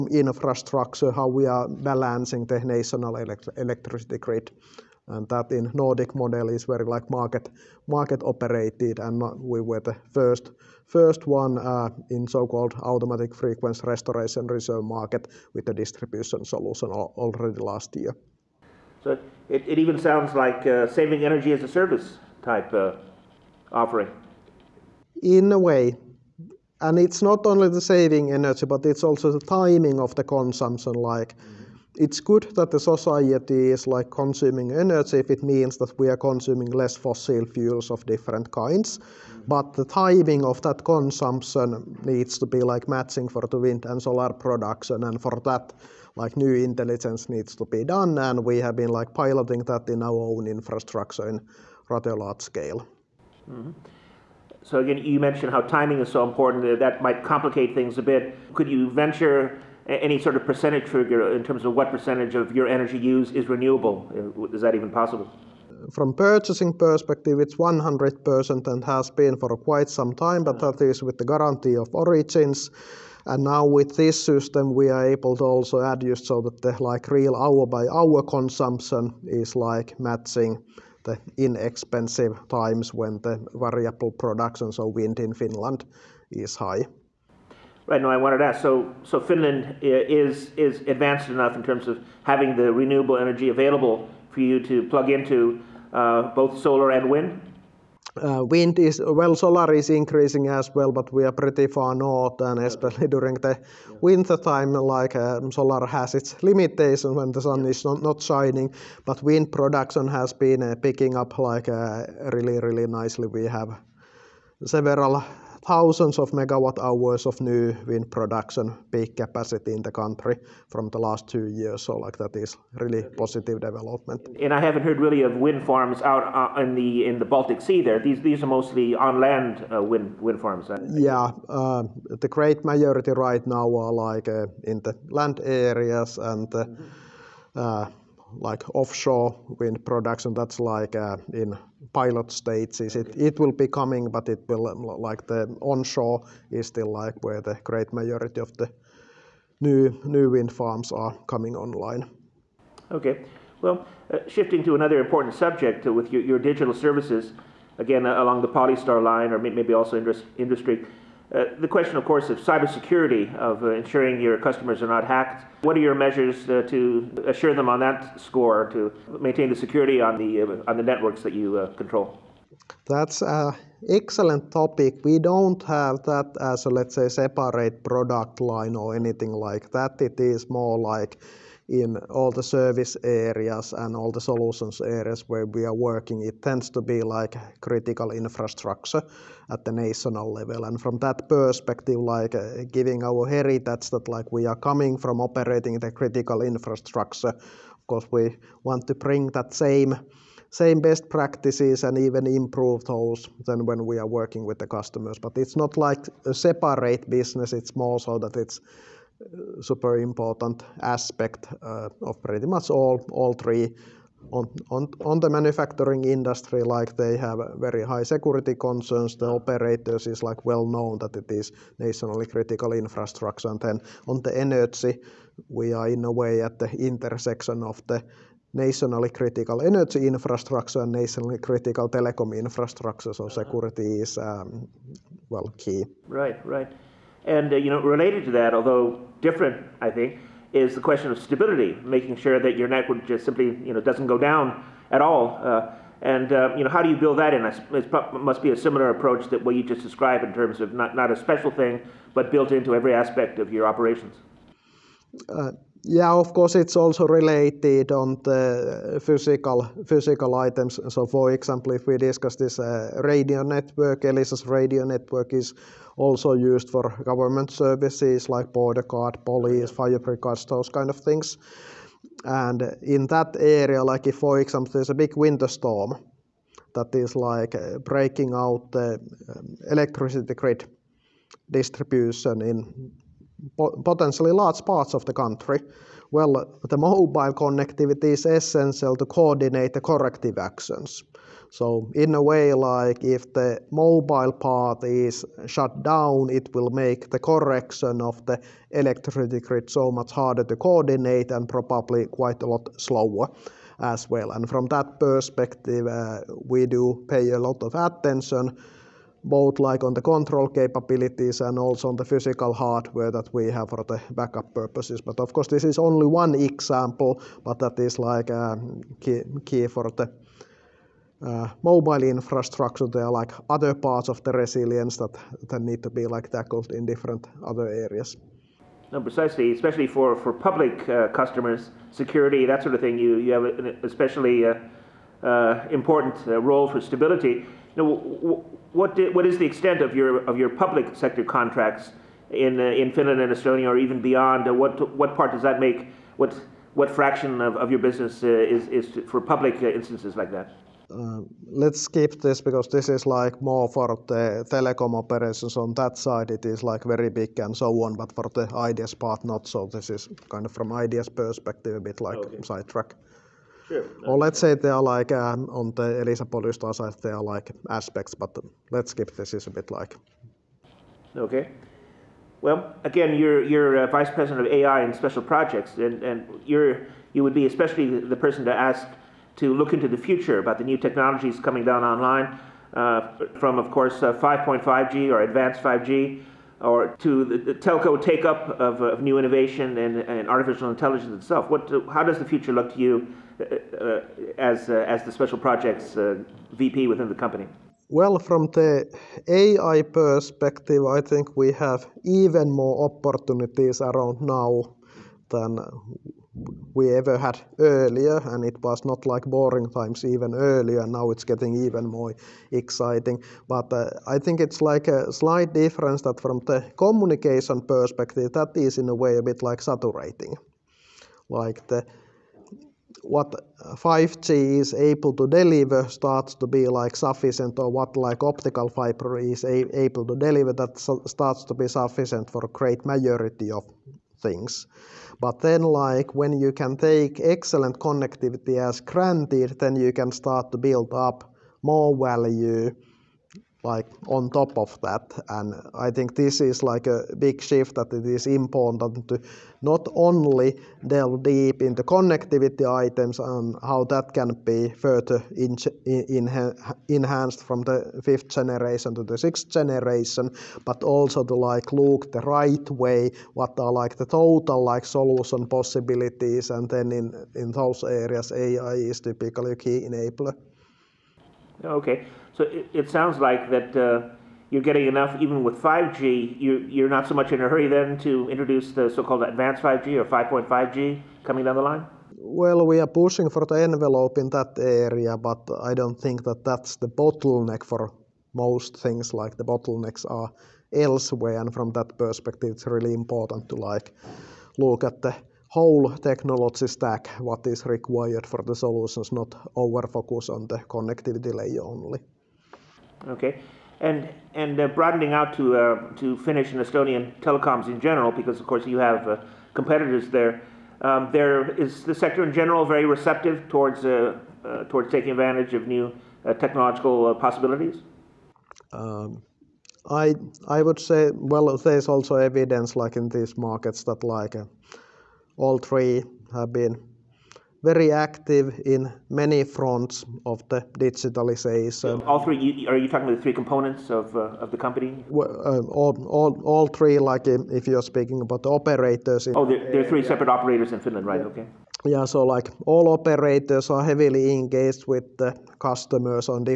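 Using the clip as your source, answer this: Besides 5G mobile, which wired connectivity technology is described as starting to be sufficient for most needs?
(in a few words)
optical fiber.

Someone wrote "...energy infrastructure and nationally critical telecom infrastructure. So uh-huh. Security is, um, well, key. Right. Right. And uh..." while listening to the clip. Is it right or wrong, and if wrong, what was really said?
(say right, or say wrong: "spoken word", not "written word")
right.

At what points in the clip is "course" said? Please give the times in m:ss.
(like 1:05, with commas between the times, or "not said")
2:42, 3:17, 4:16, 5:15, 6:23, 8:28.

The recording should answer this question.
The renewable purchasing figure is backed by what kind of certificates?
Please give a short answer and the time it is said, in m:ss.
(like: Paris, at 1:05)
guarantee of origins, at 1:11.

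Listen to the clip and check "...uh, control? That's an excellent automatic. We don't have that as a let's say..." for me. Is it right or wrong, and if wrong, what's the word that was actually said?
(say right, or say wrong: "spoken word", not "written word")
wrong: "topic", not "automatic".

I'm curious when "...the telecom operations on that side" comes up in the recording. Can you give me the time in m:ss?
5:54.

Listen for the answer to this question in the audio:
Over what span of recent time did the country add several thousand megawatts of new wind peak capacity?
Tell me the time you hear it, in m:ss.
2:00.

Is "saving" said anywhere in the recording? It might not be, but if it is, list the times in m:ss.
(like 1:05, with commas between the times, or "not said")
0:20, 0:27.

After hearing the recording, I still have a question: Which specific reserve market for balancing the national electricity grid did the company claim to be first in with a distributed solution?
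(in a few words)
automatic frequency restoration reserve.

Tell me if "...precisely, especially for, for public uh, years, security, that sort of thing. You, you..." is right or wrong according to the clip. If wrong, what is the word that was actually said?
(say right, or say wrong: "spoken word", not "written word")
wrong: "customers", not "years".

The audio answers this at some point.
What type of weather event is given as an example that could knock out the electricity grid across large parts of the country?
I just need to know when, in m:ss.
4:35.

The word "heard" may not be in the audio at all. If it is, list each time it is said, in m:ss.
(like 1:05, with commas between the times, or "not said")
2:04.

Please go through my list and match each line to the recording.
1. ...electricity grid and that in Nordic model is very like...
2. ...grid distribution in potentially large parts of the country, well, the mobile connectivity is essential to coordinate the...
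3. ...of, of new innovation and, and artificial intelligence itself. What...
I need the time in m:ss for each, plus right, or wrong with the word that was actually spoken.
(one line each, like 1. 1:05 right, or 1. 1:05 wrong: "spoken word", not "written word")
1. 0:03 right
2. 4:40 right
3. 6:28 right.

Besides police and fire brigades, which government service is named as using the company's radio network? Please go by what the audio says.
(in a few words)
border guard.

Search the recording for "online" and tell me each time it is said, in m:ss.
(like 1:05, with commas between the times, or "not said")
2:31, 6:21.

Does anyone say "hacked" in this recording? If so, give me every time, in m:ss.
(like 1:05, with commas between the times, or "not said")
2:45.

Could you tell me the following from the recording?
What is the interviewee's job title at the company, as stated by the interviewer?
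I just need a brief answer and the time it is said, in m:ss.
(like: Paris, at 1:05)
vice president of AI and special projects, at 6:13.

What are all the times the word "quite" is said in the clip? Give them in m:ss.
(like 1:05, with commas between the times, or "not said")
1:09, 5:02.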